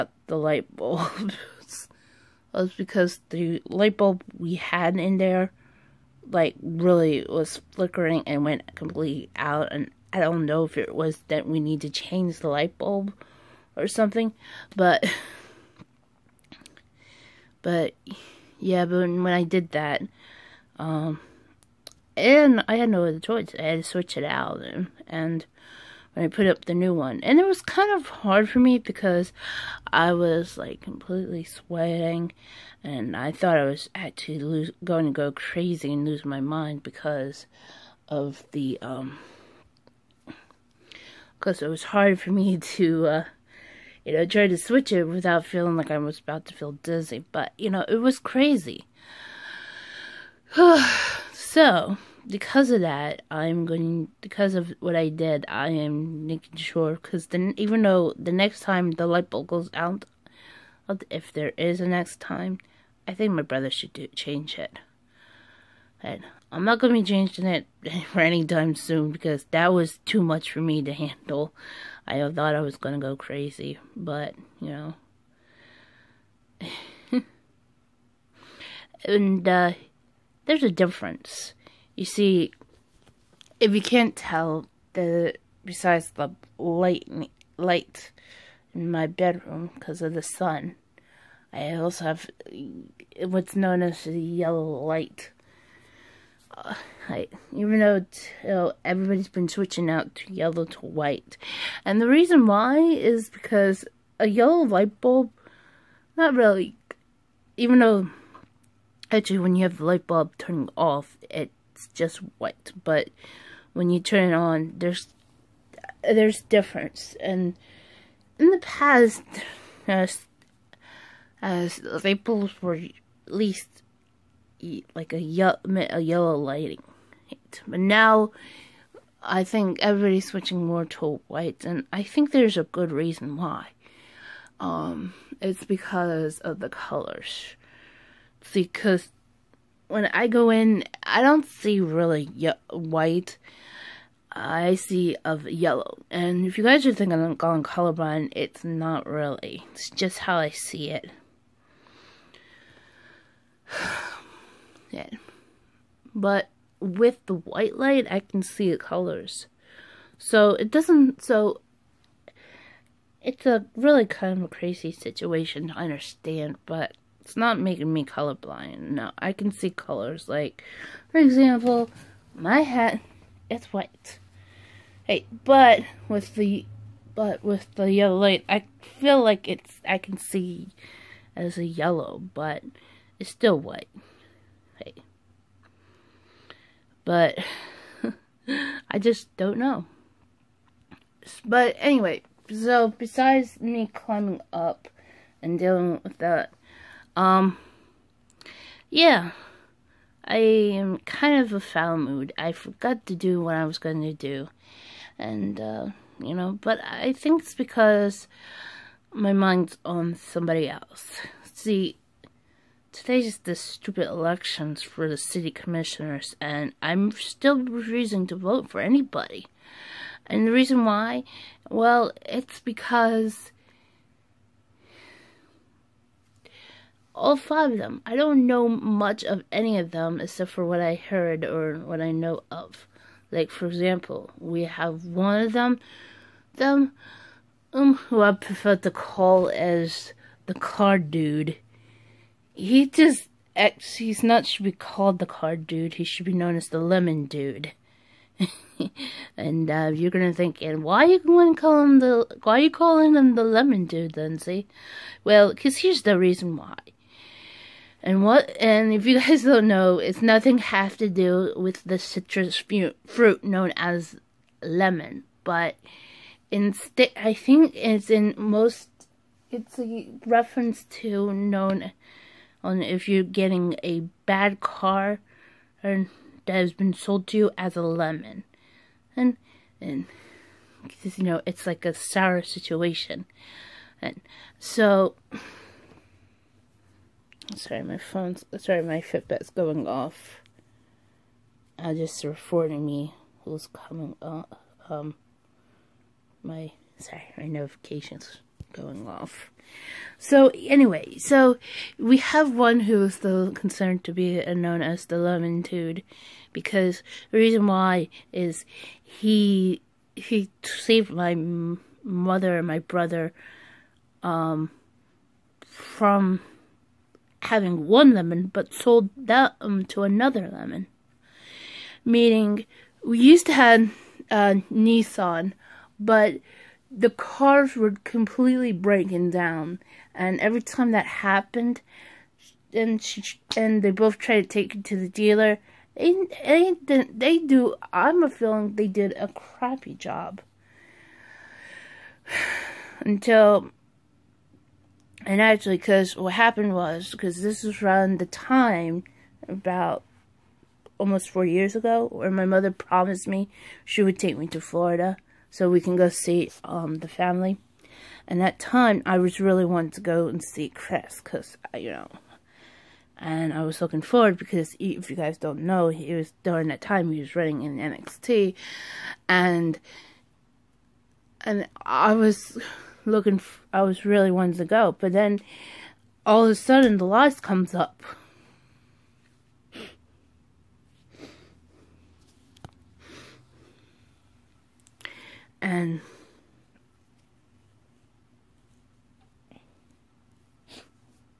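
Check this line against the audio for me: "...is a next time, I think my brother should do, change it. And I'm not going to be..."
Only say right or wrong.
right.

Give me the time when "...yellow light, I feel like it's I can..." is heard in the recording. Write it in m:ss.
2:57.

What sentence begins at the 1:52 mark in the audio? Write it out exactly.
But when you turn it on, there's there's difference.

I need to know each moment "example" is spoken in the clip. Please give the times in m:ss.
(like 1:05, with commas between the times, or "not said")
2:51, 3:53.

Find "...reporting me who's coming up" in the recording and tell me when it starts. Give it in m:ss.
4:52.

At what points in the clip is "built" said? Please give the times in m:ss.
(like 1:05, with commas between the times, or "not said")
not said.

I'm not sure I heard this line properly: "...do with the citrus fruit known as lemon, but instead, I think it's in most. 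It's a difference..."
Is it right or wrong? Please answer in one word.
wrong.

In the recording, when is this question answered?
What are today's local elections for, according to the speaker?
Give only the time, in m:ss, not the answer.
3:35.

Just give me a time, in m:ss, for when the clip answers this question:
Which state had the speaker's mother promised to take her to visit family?
5:54.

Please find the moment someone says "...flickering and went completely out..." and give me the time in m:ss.
0:07.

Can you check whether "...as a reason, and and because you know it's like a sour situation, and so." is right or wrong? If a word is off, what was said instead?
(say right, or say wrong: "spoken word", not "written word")
wrong: "lemon", not "reason".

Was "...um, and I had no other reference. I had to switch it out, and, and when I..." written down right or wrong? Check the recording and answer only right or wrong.
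wrong.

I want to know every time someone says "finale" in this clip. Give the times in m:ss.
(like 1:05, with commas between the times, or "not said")
not said.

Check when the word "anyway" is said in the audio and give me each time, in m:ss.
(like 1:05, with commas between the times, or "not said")
3:11, 5:00.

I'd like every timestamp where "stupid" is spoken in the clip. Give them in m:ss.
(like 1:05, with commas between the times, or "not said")
3:33.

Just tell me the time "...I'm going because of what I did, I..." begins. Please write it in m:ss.
0:53.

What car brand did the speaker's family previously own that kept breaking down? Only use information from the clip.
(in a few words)
Nissan.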